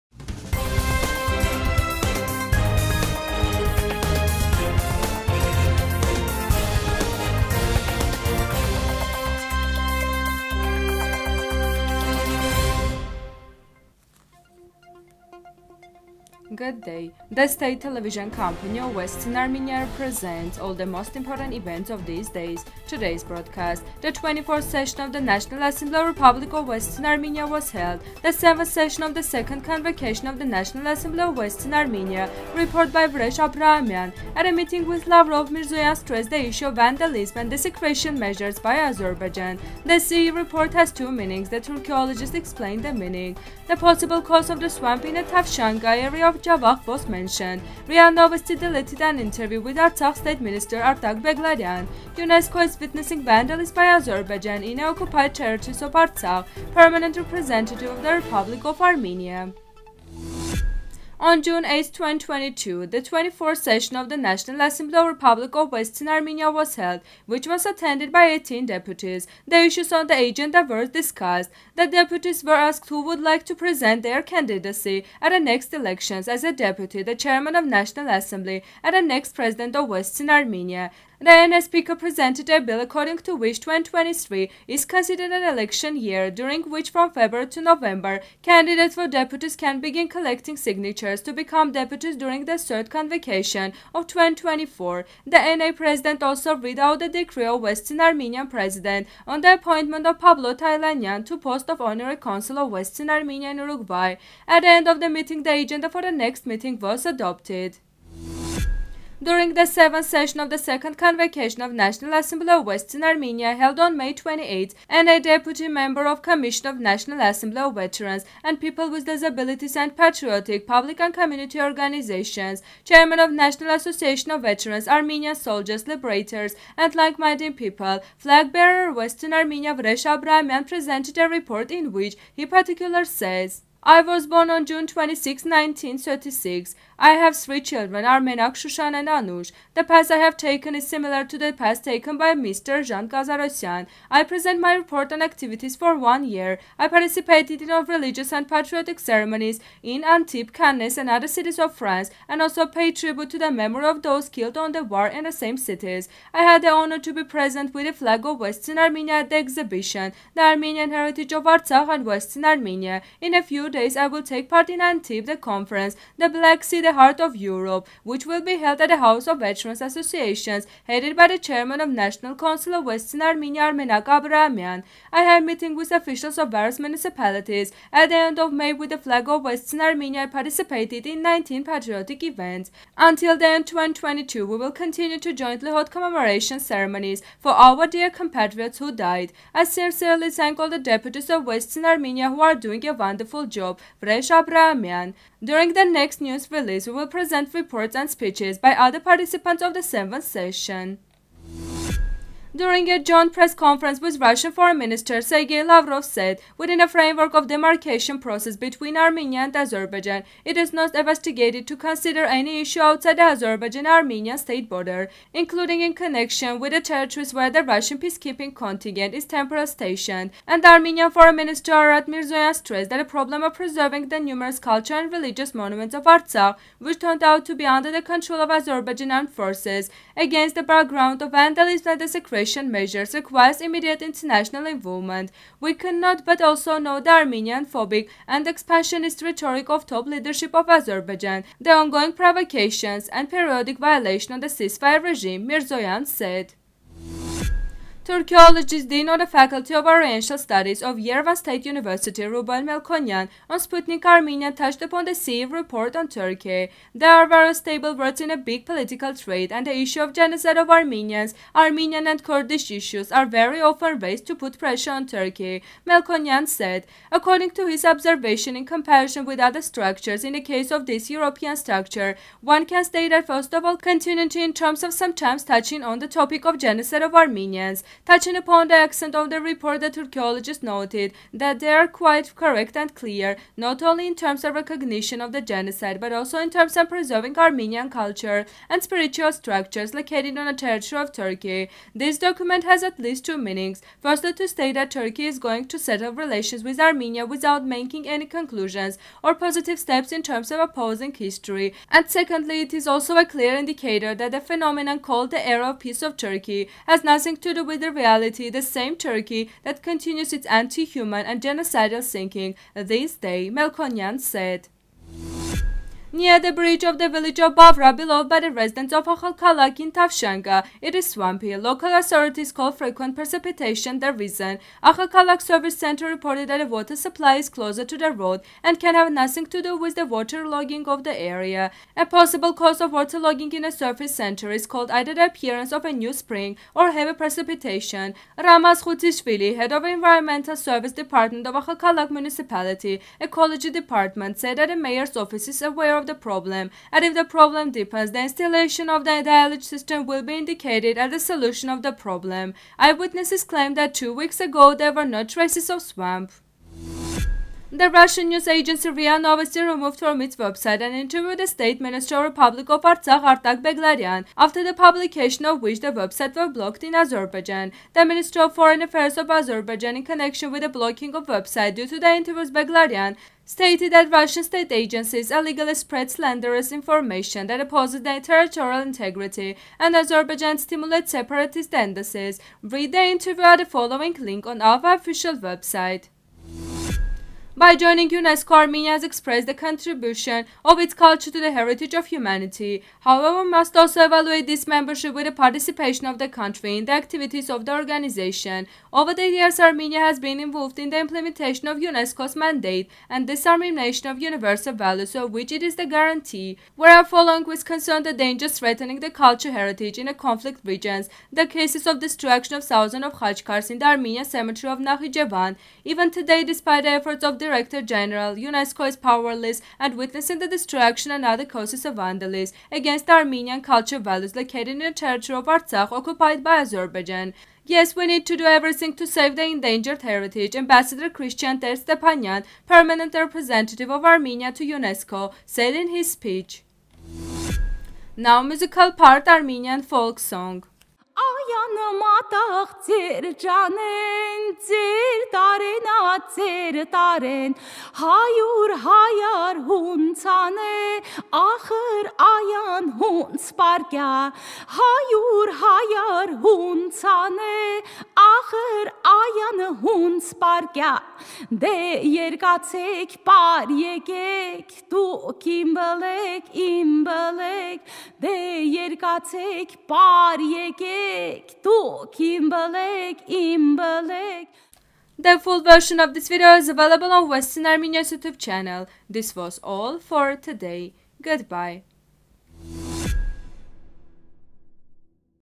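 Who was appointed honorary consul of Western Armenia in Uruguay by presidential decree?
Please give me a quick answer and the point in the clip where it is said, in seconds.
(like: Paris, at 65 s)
Pablo Taylanyan, at 100 s.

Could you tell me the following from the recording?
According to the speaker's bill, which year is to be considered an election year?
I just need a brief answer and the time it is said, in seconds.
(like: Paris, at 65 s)
2023, at 83 s.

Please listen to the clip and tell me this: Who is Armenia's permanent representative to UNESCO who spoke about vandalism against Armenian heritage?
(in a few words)
Christian Ter Stepanyan.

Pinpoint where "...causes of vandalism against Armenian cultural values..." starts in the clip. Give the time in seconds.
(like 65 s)
421 s.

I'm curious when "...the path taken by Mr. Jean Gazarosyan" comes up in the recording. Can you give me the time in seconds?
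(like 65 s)
141 s.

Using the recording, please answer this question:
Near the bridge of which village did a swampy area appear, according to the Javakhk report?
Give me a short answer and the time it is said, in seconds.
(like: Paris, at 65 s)
Bavra, at 317 s.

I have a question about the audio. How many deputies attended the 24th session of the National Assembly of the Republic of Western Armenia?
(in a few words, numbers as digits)
18.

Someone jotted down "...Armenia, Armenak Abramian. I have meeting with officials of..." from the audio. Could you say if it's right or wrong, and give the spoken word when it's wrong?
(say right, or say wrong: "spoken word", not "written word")
right.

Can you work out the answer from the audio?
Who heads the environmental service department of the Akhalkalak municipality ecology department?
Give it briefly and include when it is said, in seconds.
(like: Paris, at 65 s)
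Ramaz Khutishvili, at 338 s.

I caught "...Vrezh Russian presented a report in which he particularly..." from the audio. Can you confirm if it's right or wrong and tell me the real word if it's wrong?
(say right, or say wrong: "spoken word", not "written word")
wrong: "Abramian", not "Russian".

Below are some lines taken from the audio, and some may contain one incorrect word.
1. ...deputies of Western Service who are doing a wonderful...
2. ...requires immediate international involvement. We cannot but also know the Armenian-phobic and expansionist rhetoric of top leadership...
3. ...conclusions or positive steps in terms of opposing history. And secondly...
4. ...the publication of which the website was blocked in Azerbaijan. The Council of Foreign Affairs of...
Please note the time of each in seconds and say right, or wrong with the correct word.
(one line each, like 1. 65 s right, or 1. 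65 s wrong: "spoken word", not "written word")
1. 190 s wrong: "Armenia", not "Service"
2. 233 s right
3. 298 s right
4. 364 s wrong: "Minister", not "Council".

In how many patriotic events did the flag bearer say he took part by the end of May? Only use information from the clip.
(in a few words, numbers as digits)
19.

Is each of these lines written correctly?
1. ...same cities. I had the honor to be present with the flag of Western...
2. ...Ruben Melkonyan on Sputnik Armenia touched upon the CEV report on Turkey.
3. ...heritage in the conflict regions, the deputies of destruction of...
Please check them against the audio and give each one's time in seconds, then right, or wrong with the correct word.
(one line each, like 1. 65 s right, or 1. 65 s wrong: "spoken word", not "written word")
1. 155 s right
2. 252 s right
3. 409 s wrong: "cases", not "deputies".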